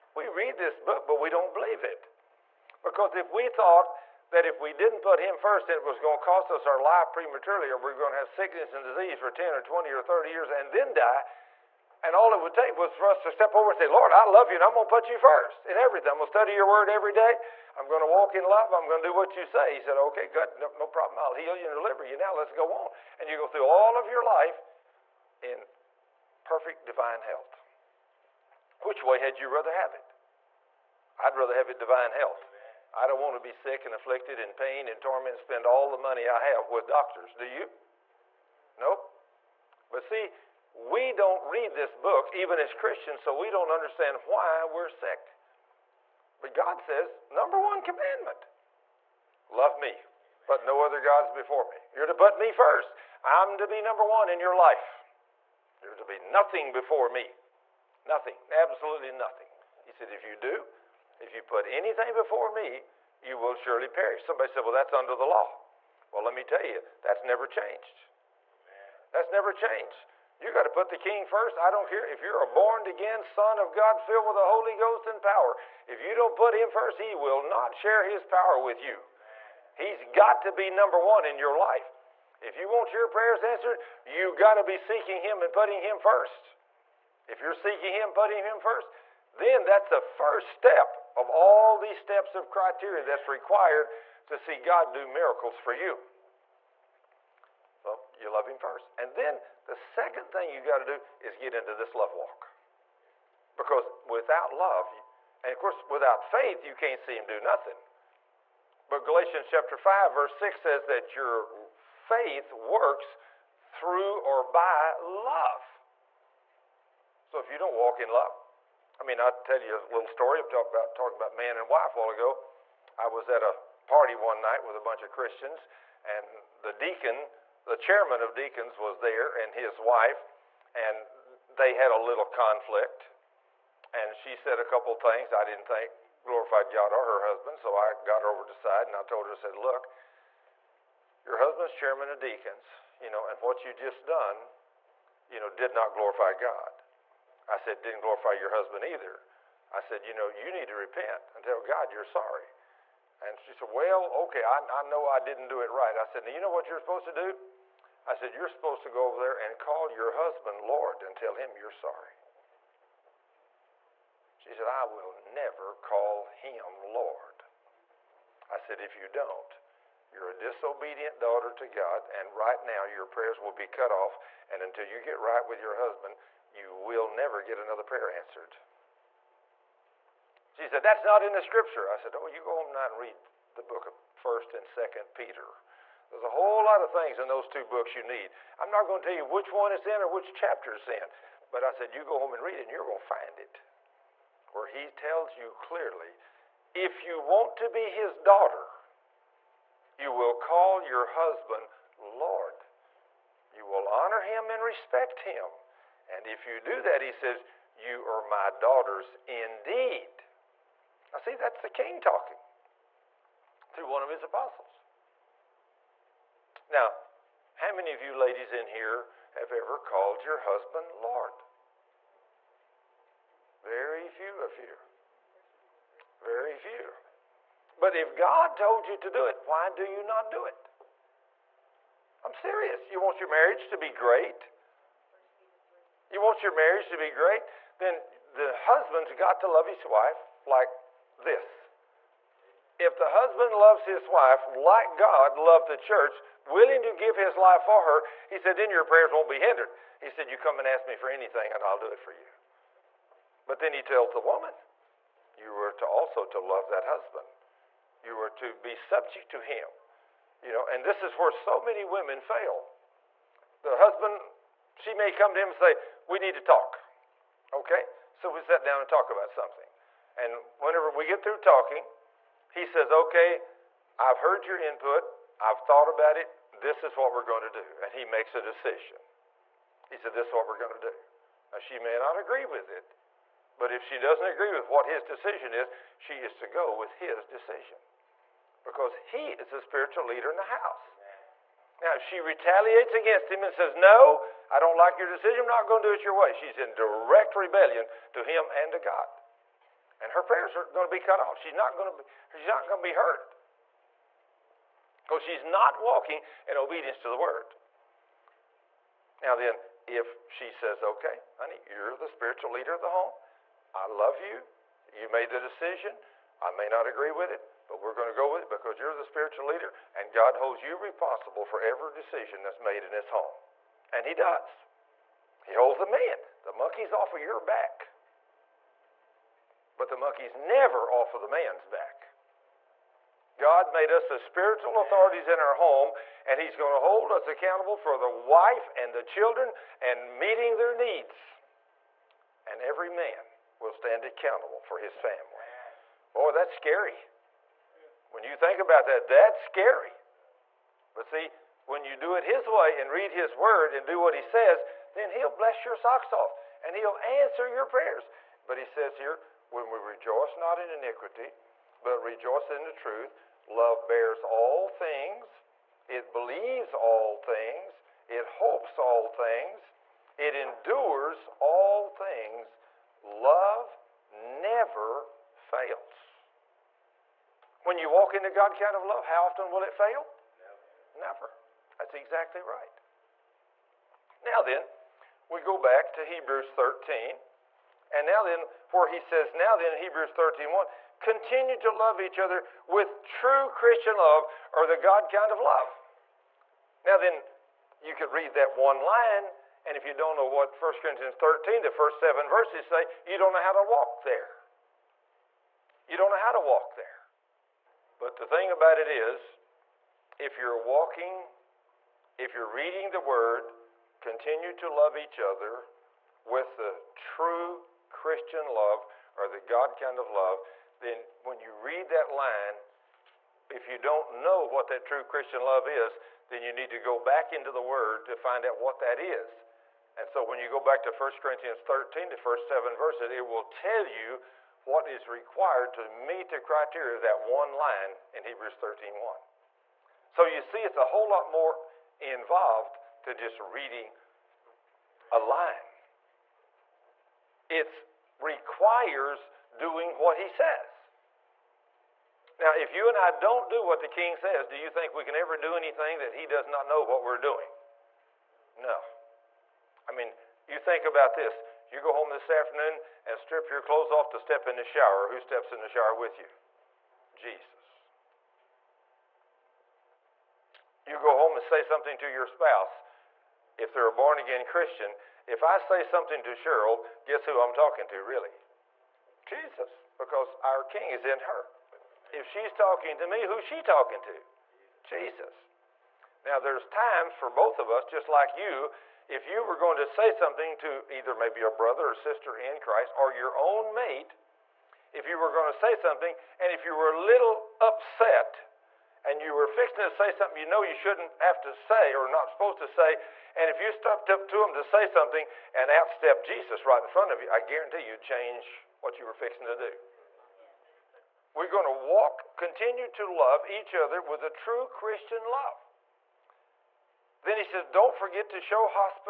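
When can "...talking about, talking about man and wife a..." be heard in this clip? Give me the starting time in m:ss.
2:00.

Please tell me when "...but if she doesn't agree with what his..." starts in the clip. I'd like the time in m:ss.
4:43.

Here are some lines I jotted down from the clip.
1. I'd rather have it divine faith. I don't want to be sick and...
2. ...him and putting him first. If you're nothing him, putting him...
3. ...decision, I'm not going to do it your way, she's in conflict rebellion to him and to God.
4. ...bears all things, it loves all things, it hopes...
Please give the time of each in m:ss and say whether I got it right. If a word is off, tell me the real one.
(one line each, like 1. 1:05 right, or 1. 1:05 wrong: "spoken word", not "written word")
1. 0:31 wrong: "health", not "faith"
2. 1:25 wrong: "seeking", not "nothing"
3. 4:55 wrong: "direct", not "conflict"
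4. 6:03 wrong: "believes", not "loves".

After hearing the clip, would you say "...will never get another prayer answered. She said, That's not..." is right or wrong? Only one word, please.
right.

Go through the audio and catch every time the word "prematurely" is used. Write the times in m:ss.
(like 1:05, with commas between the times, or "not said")
0:07.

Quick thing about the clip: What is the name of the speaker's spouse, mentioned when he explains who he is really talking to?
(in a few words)
Cheryl.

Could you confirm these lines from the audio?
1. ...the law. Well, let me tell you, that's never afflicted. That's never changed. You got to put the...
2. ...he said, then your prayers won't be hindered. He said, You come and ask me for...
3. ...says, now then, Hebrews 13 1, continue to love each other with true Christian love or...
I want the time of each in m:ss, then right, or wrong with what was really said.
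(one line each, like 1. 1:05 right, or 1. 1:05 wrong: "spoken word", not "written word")
1. 1:05 wrong: "changed", not "afflicted"
2. 4:08 right
3. 6:28 right.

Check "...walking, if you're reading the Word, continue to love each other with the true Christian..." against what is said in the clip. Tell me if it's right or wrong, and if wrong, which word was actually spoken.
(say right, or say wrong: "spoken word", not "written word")
right.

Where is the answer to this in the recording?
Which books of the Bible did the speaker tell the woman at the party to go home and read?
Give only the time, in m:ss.
3:04.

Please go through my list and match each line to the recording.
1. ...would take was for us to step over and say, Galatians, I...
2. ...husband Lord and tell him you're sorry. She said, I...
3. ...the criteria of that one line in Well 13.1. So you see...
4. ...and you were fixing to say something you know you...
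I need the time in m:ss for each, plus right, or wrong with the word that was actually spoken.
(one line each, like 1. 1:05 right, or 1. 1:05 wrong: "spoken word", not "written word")
1. 0:12 wrong: "Lord", not "Galatians"
2. 2:40 right
3. 7:16 wrong: "Hebrews", not "Well"
4. 8:19 right.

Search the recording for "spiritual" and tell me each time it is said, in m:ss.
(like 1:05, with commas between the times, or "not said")
4:49, 5:12, 5:19, 5:34.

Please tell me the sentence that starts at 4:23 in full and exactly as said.
The husband she may come to him and say, We need to talk.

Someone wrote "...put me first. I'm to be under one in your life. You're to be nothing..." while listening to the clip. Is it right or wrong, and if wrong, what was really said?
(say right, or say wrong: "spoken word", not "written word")
wrong: "number", not "under".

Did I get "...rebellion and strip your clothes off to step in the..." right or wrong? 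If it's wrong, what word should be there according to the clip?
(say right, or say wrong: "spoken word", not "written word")
wrong: "afternoon", not "rebellion".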